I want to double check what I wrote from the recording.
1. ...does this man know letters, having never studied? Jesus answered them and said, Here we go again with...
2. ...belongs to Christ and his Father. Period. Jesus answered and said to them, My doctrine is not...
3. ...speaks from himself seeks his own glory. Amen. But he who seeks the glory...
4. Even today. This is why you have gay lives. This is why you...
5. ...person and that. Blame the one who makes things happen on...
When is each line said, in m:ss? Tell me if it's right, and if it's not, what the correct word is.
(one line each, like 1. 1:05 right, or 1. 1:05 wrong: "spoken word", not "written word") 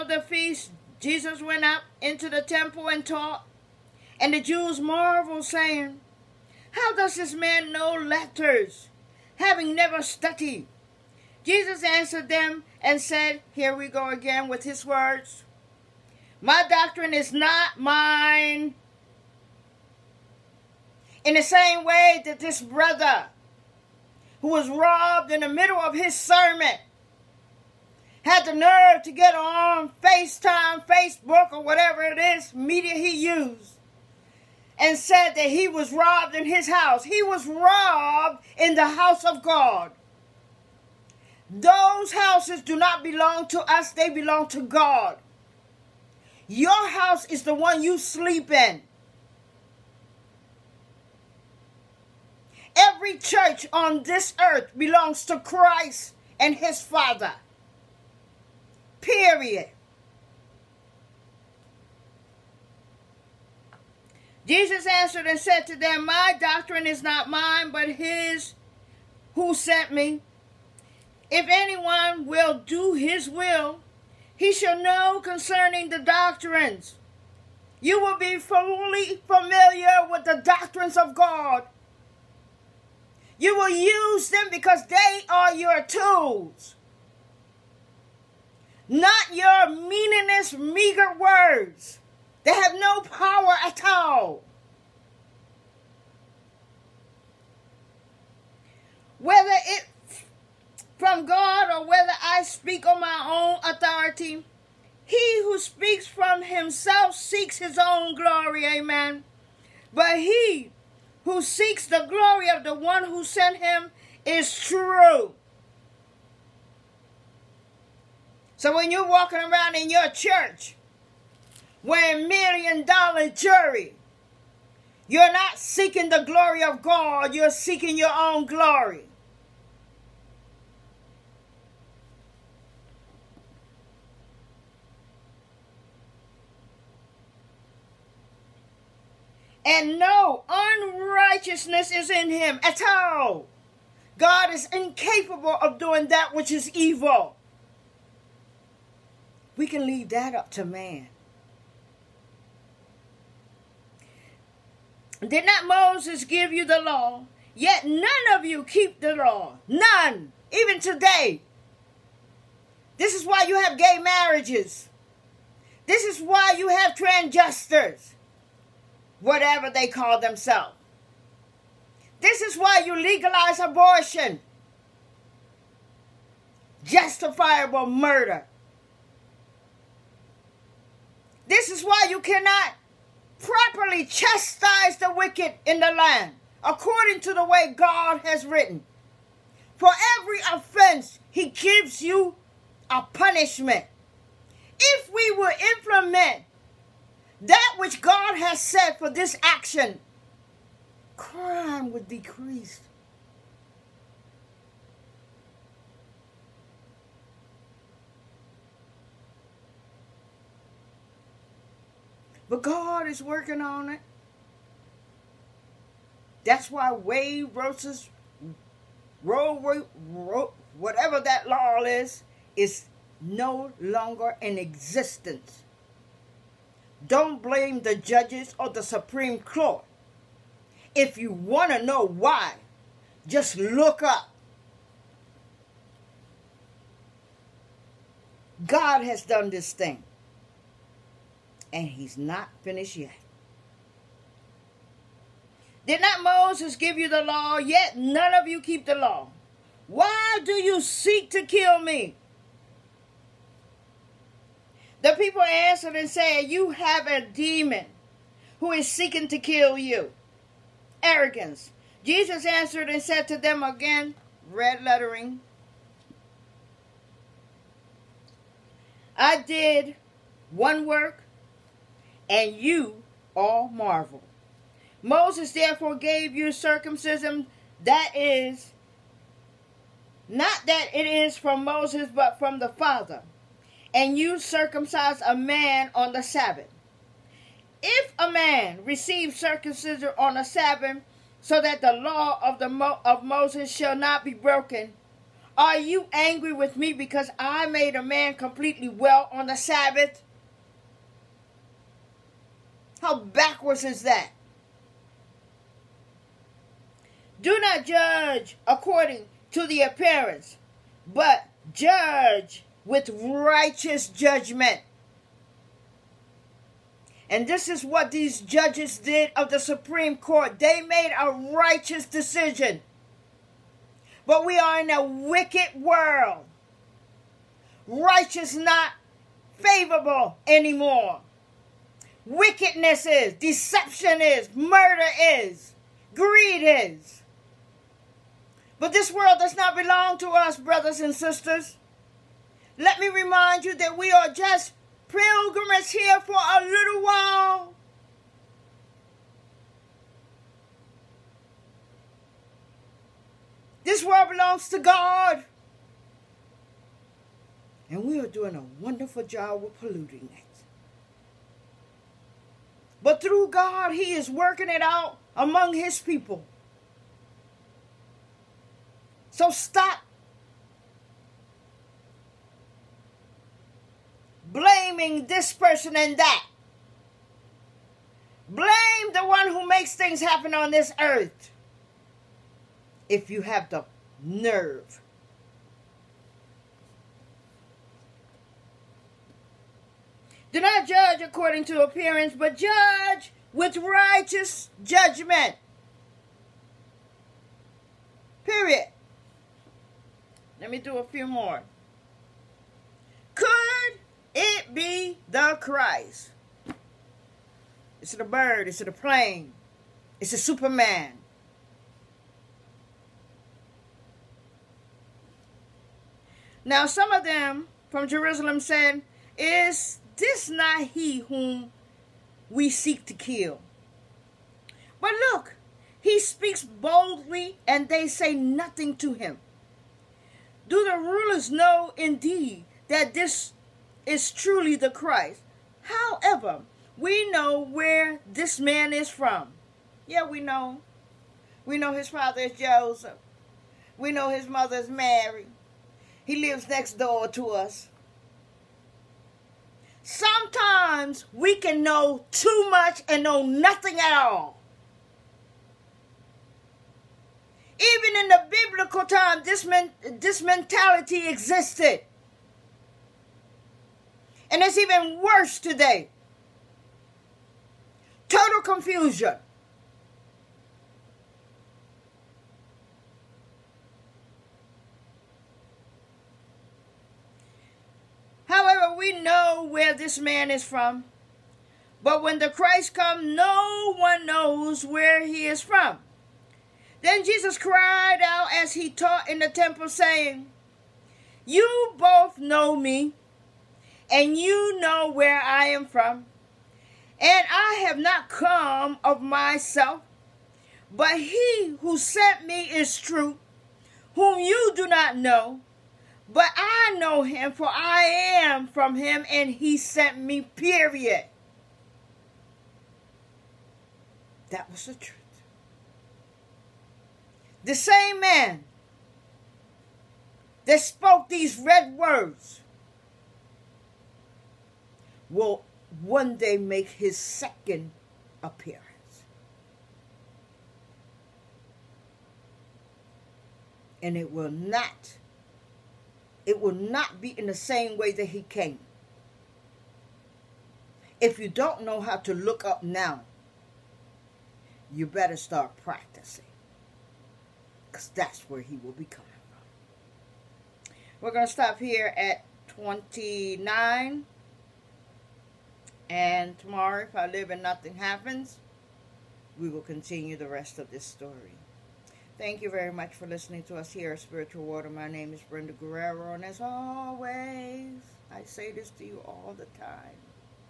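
1. 0:06 right
2. 0:54 right
3. 1:45 right
4. 2:40 wrong: "marriages", not "lives"
5. 6:15 right.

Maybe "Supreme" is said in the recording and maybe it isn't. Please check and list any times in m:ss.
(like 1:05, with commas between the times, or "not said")
3:48, 5:19.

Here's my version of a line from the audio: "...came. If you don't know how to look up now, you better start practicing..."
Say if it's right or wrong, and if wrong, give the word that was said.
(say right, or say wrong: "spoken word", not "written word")
right.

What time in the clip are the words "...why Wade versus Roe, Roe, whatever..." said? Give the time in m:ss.
3:36.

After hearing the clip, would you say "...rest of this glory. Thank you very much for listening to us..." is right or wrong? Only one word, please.
wrong.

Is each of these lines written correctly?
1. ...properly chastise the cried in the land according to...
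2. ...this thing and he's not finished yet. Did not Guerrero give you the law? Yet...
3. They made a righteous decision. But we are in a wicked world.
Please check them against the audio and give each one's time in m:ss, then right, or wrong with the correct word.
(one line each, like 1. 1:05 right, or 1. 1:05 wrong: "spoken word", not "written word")
1. 3:03 wrong: "wicked", not "cried"
2. 3:59 wrong: "Moses", not "Guerrero"
3. 5:20 right.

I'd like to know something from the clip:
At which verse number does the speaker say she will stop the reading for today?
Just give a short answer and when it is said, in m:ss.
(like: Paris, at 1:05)
29, at 9:12.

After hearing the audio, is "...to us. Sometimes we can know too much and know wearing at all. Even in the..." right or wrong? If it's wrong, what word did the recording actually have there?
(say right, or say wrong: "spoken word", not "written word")
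wrong: "nothing", not "wearing".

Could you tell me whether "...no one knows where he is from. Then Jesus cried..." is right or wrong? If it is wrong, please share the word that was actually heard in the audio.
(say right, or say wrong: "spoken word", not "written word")
right.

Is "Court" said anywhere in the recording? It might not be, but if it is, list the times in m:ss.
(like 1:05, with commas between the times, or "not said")
3:49, 5:20.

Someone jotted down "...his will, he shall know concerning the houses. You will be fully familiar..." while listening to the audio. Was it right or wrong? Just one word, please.
wrong.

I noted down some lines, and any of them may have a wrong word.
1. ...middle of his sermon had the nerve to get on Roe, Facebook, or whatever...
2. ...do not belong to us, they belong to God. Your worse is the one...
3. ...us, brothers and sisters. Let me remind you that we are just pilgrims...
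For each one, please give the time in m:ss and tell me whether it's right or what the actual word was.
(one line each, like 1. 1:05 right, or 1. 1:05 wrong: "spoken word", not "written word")
1. 0:25 wrong: "FaceTime", not "Roe"
2. 0:42 wrong: "house", not "worse"
3. 5:40 right.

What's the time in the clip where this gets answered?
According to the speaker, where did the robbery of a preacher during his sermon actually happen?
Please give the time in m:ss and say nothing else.
0:38.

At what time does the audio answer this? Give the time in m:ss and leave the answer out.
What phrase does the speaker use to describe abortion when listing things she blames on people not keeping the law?
2:56.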